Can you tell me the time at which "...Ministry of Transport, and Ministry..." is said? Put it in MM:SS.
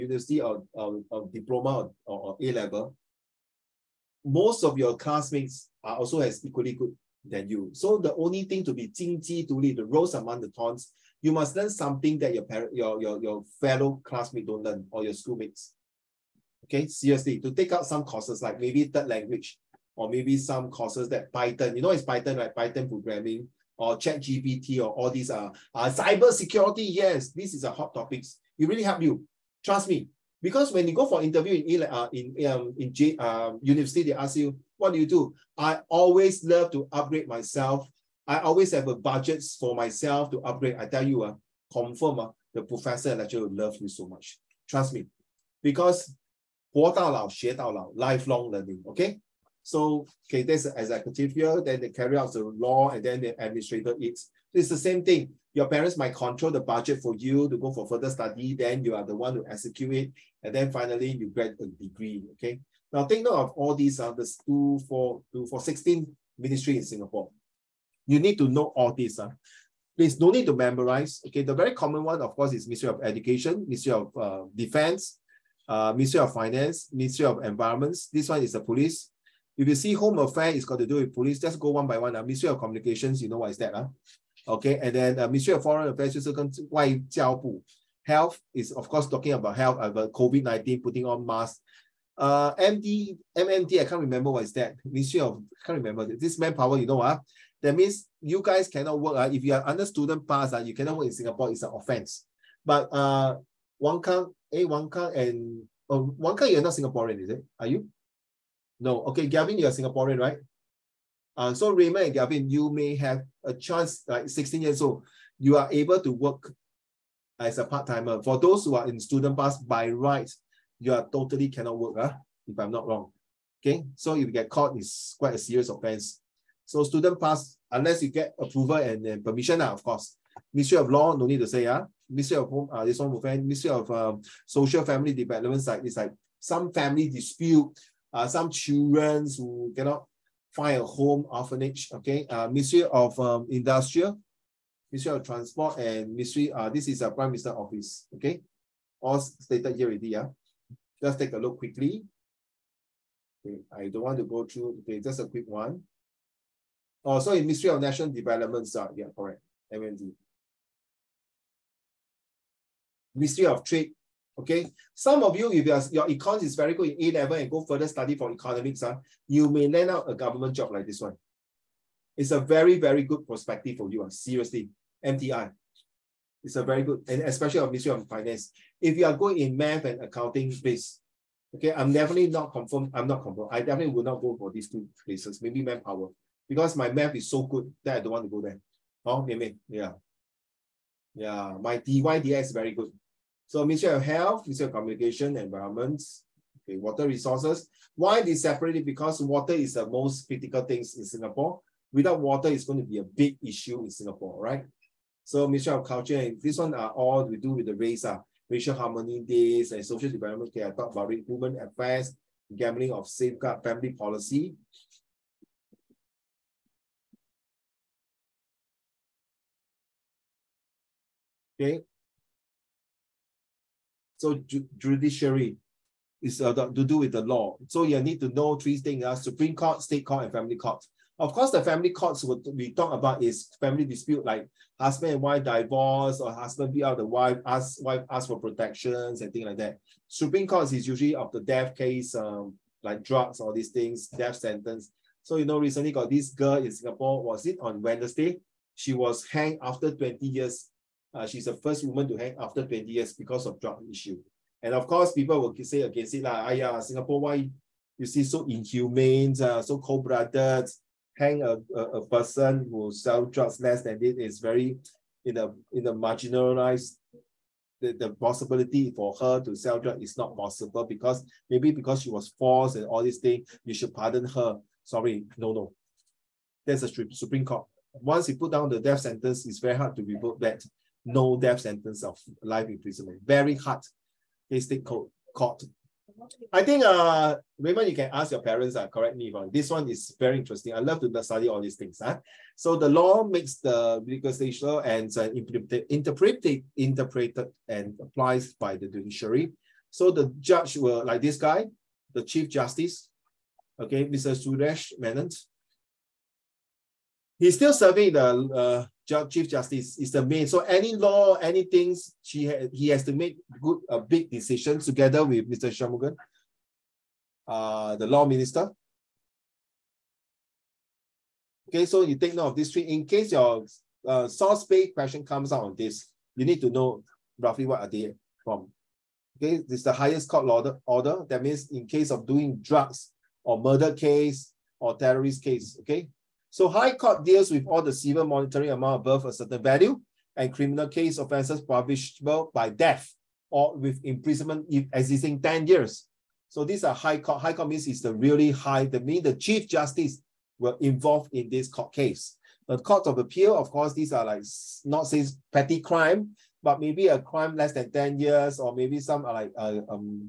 02:24.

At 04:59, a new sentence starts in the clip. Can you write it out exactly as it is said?
So the judge will, like this guy, the Chief Justice, okay, Mr.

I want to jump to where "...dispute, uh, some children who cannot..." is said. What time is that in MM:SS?
02:17.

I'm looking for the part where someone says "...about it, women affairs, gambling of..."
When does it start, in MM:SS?
03:30.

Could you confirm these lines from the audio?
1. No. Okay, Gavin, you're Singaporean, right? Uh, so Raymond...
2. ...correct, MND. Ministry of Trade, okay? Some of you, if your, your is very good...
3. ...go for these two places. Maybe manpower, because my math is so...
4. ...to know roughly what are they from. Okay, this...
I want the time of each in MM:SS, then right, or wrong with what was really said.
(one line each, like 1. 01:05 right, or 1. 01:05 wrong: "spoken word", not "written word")
1. 01:48 right
2. 02:39 right
3. 03:04 right
4. 05:26 right.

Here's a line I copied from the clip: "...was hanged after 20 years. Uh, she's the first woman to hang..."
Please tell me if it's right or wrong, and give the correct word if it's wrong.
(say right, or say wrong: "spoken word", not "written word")
right.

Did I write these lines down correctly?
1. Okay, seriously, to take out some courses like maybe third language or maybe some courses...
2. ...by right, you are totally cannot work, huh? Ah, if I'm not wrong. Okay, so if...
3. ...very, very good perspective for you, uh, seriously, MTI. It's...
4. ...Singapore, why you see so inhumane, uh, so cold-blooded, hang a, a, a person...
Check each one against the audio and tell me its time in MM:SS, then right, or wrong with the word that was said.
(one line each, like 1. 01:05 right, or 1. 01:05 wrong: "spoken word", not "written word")
1. 00:16 right
2. 01:59 right
3. 02:52 right
4. 04:16 right.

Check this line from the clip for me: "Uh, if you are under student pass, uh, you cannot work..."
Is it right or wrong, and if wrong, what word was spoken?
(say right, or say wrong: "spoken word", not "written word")
right.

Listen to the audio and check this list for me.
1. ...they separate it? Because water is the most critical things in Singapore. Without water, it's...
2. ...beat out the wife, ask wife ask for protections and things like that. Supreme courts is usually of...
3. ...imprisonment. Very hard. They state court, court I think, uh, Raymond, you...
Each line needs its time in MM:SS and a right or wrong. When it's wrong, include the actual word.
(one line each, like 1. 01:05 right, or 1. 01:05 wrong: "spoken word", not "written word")
1. 03:18 right
2. 03:56 right
3. 04:42 right.